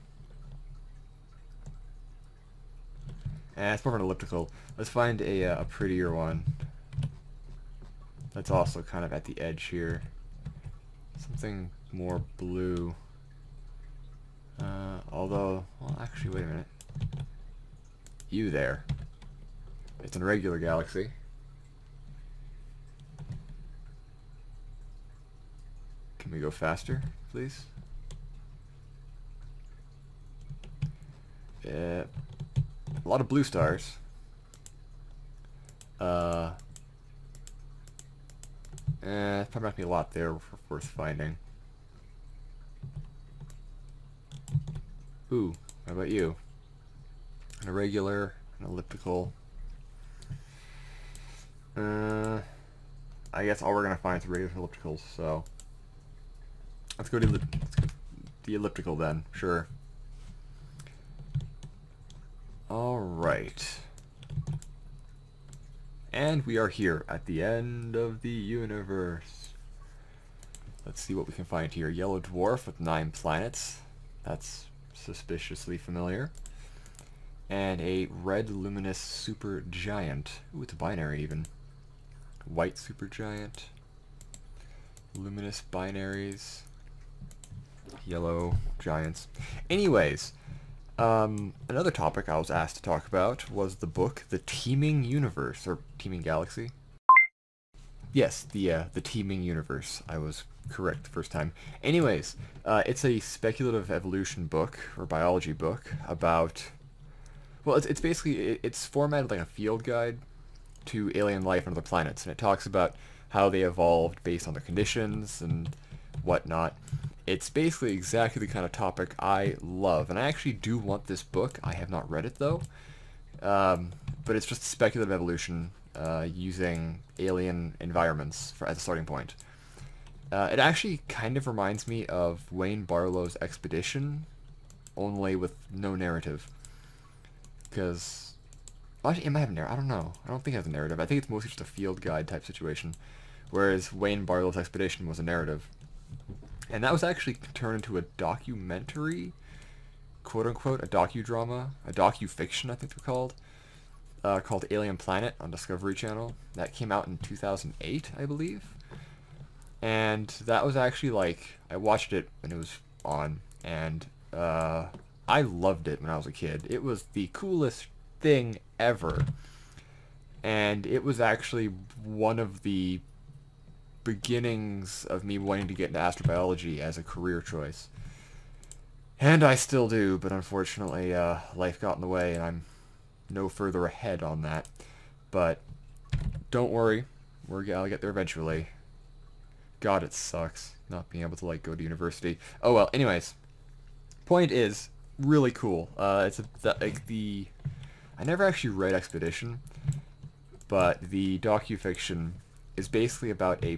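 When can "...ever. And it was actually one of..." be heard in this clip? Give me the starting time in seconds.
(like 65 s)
168 s.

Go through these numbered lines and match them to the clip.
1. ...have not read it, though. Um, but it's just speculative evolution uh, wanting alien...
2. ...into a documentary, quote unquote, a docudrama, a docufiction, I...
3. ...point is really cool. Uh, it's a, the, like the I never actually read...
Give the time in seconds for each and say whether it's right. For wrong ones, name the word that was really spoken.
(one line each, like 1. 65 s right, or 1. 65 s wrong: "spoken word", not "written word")
1. 121 s wrong: "using", not "wanting"
2. 147 s right
3. 194 s right.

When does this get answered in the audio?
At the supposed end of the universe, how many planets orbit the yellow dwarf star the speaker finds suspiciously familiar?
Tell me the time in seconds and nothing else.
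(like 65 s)
72 s.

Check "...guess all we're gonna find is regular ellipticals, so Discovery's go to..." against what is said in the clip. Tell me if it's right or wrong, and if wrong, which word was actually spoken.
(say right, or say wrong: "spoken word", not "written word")
wrong: "Let", not "Discovery".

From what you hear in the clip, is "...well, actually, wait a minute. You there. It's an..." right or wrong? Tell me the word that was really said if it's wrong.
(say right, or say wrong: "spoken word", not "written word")
right.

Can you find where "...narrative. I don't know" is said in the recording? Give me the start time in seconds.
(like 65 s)
139 s.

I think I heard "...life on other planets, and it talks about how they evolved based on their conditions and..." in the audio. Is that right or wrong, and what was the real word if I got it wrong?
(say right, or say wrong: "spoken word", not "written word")
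right.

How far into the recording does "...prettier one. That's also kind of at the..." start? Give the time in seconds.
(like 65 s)
5 s.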